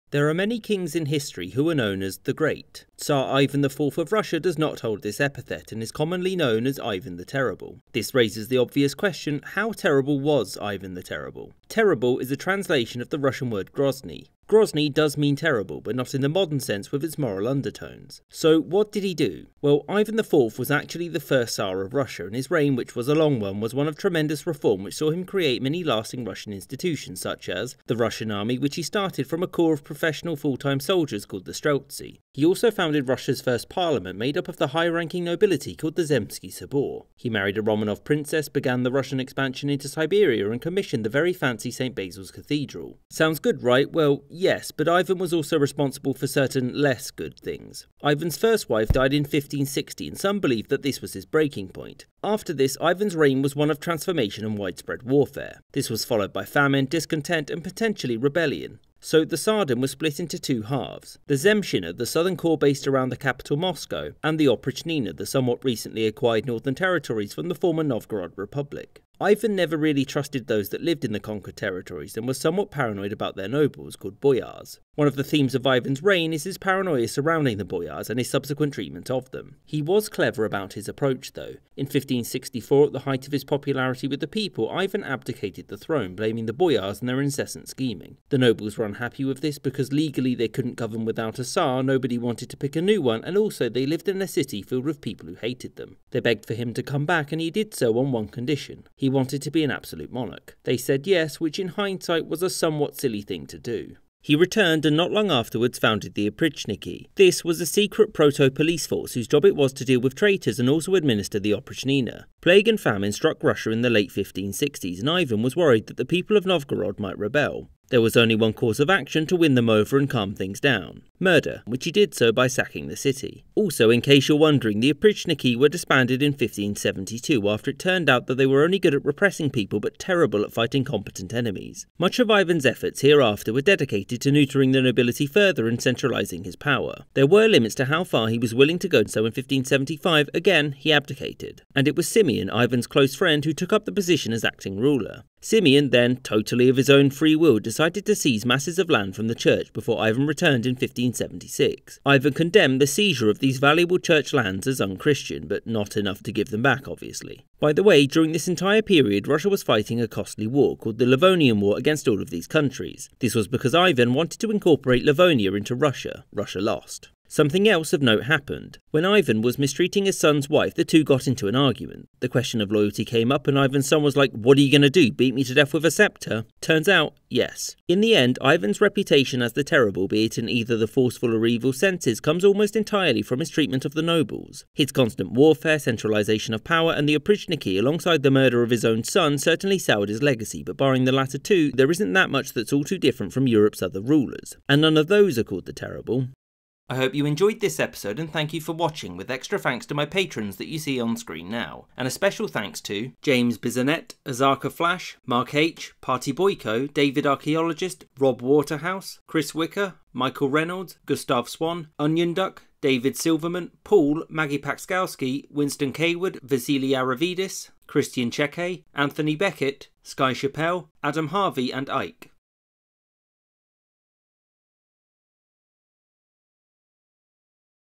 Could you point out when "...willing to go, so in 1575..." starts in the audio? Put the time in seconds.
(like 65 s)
138 s.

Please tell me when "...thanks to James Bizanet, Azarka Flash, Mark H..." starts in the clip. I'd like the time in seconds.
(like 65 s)
202 s.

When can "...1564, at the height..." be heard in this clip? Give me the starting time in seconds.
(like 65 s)
81 s.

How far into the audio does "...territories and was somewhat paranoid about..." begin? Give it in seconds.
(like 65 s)
71 s.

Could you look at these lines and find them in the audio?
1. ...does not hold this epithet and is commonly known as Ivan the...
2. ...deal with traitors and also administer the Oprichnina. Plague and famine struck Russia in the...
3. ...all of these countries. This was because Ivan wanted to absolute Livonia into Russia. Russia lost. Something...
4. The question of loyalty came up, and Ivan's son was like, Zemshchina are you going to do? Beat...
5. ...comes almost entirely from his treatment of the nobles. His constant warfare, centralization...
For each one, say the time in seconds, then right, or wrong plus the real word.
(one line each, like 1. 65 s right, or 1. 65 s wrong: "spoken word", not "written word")
1. 4 s right
2. 109 s right
3. 162 s wrong: "incorporate", not "absolute"
4. 172 s wrong: "What", not "Zemshchina"
5. 182 s right.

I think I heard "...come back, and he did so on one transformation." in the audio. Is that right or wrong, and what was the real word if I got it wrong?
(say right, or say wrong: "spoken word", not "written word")
wrong: "condition", not "transformation".